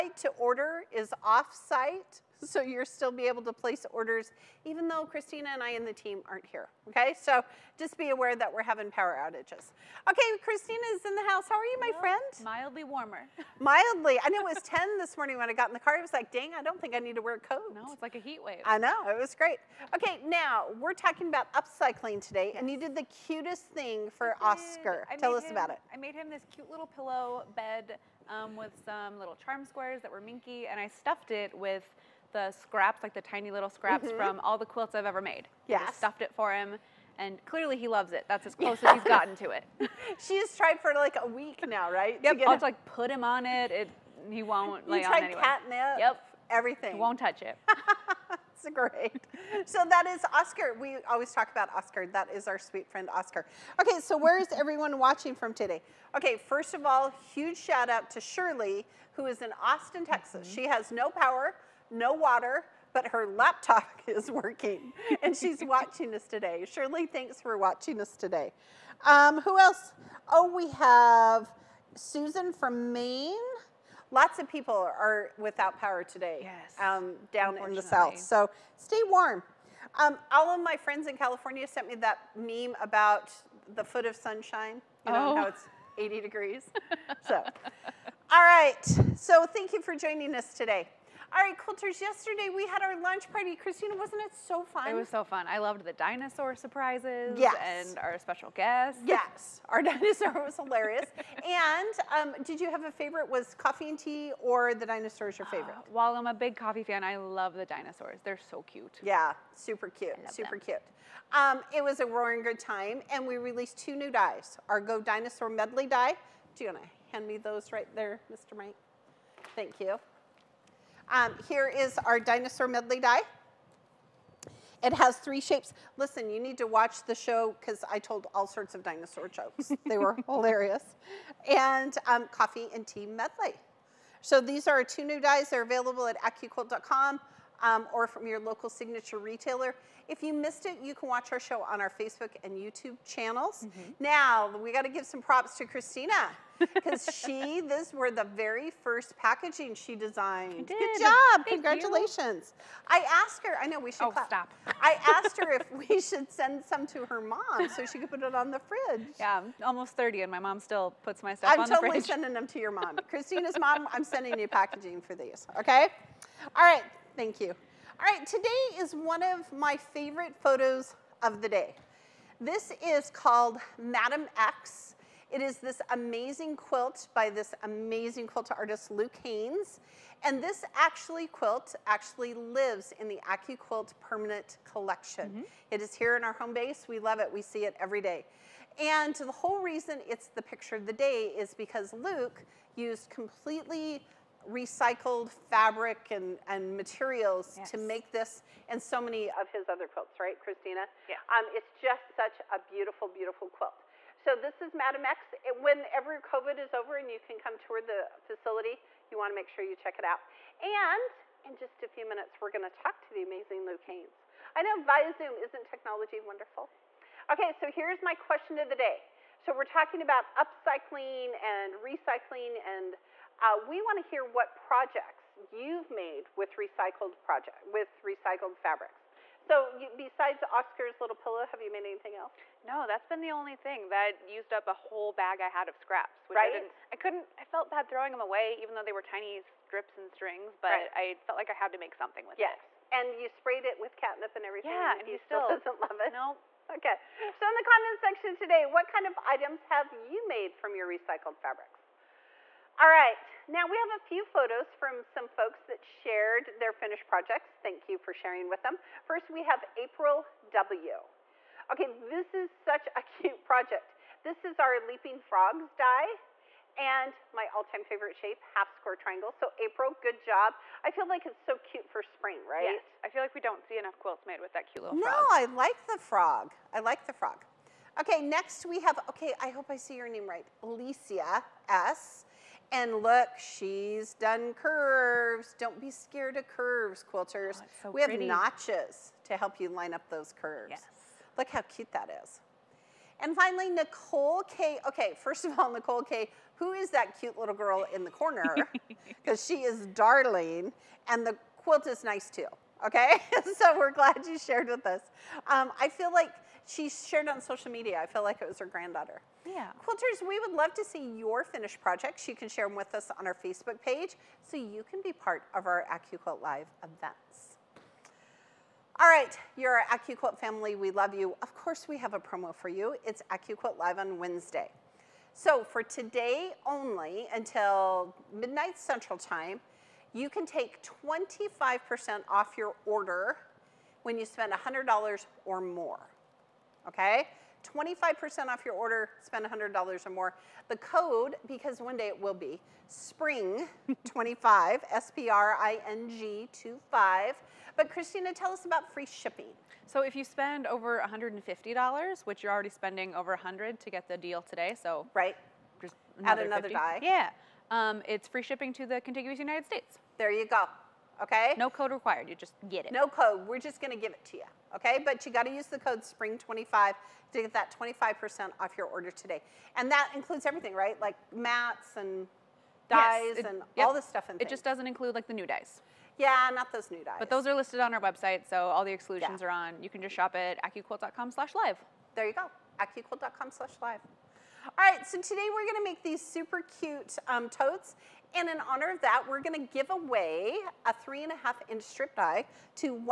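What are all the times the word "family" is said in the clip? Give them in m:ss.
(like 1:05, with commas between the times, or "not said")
5:20.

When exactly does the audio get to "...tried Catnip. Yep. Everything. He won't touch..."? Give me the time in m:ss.
0:45.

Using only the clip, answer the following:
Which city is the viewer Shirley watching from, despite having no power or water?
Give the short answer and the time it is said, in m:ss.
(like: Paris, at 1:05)
Austin, Texas, at 0:59.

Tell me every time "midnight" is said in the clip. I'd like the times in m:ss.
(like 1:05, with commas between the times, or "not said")
5:28.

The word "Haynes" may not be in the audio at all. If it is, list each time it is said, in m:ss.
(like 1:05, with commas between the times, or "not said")
2:59, 3:33.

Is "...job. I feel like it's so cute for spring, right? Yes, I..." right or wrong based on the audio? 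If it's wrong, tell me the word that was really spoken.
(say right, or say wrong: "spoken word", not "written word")
right.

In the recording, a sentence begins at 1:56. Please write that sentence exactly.
Do you want to hand me those right there, Mr.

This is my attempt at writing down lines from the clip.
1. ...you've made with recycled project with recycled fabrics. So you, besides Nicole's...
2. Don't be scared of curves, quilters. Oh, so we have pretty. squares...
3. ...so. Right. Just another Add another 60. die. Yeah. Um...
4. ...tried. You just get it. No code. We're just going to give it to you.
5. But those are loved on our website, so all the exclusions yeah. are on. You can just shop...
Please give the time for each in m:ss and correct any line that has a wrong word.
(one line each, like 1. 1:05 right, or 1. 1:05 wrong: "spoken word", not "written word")
1. 3:45 wrong: "Oscar", not "Nicole"
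2. 4:45 wrong: "notches", not "squares"
3. 5:54 wrong: "50", not "60"
4. 6:01 wrong: "required", not "tried"
5. 6:17 wrong: "listed", not "loved".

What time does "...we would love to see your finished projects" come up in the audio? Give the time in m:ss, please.
5:10.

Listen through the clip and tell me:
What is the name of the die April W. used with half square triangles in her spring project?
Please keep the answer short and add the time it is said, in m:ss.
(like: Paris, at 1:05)
Leaping Frogs, at 4:24.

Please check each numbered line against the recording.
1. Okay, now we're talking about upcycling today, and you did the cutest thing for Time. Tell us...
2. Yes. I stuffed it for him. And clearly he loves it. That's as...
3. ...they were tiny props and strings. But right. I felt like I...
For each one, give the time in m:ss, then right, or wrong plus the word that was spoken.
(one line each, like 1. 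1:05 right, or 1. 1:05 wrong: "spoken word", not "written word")
1. 0:19 wrong: "Oscar", not "Time"
2. 0:35 right
3. 3:58 wrong: "strips", not "props".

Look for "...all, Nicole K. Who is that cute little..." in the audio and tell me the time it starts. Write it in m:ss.
4:55.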